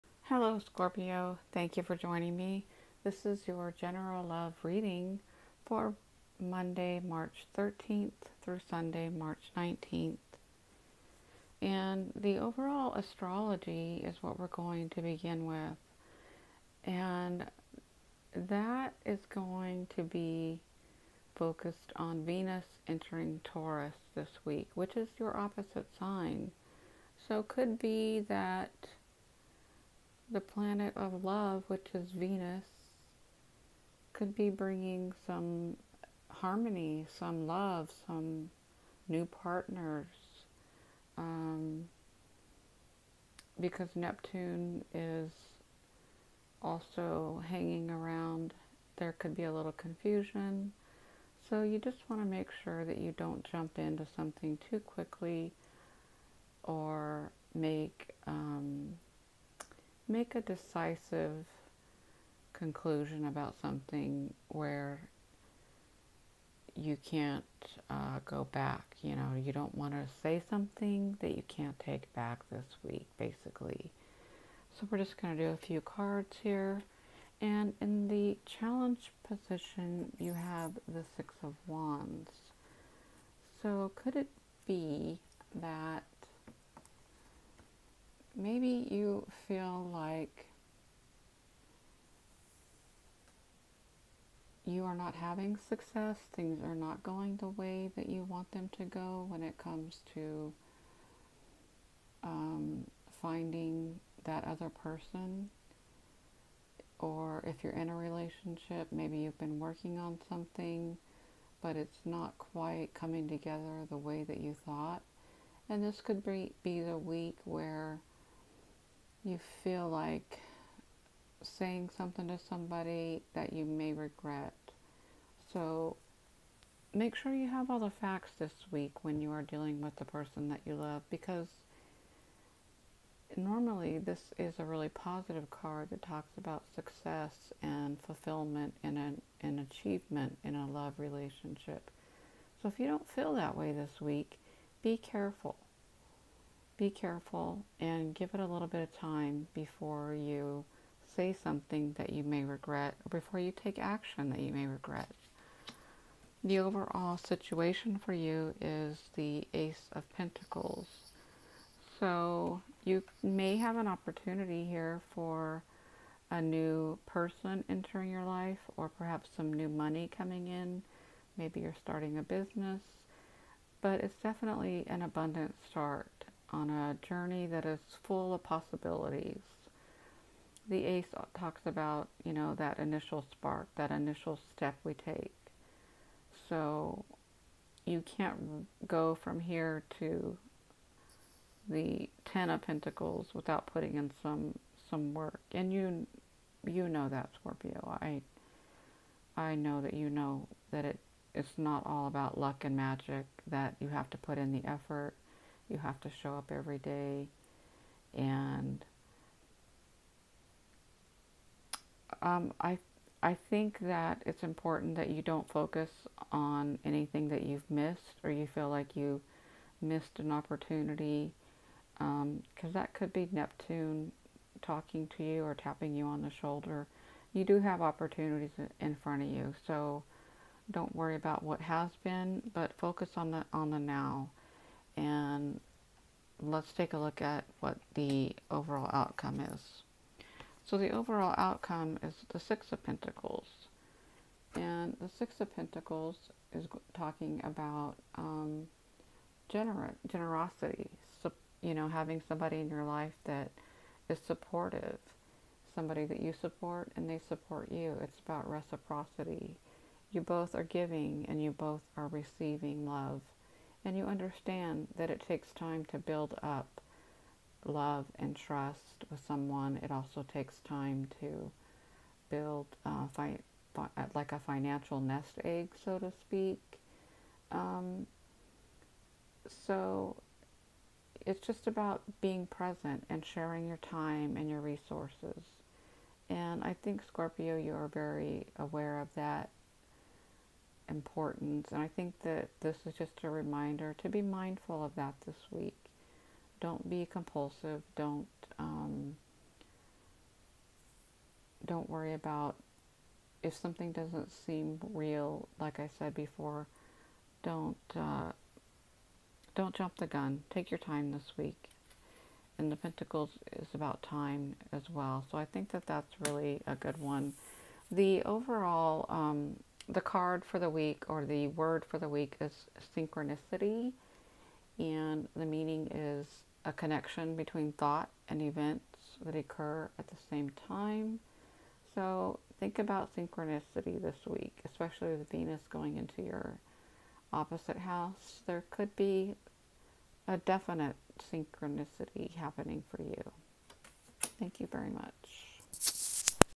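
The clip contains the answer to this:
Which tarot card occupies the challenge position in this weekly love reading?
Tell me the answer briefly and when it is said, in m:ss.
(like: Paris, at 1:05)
Six of Wands, at 1:21.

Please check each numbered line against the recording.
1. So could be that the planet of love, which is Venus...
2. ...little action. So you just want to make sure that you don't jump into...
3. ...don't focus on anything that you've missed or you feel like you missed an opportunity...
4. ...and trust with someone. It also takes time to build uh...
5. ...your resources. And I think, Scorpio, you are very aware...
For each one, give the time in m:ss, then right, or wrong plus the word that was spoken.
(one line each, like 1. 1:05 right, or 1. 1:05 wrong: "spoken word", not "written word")
1. 0:27 right
2. 0:49 wrong: "confusion", not "action"
3. 3:35 right
4. 4:28 right
5. 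4:44 right.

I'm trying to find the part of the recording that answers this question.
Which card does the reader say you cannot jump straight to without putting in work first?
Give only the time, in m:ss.
3:12.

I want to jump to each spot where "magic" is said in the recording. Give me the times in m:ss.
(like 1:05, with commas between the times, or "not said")
3:22.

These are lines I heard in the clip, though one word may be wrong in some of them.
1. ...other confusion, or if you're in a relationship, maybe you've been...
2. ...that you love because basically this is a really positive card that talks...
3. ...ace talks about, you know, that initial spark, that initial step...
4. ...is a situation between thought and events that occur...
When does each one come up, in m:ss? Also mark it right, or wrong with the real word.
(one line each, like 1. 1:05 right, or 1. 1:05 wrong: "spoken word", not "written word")
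1. 1:44 wrong: "person", not "confusion"
2. 2:10 wrong: "normally", not "basically"
3. 3:00 right
4. 5:25 wrong: "connection", not "situation".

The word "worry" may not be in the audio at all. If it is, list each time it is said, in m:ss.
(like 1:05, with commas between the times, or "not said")
3:50, 5:01.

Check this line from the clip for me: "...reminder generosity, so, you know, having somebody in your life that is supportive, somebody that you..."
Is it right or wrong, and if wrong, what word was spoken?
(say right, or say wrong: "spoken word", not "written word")
wrong: "gener", not "reminder".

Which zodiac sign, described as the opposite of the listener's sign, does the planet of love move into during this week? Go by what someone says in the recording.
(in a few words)
Taurus.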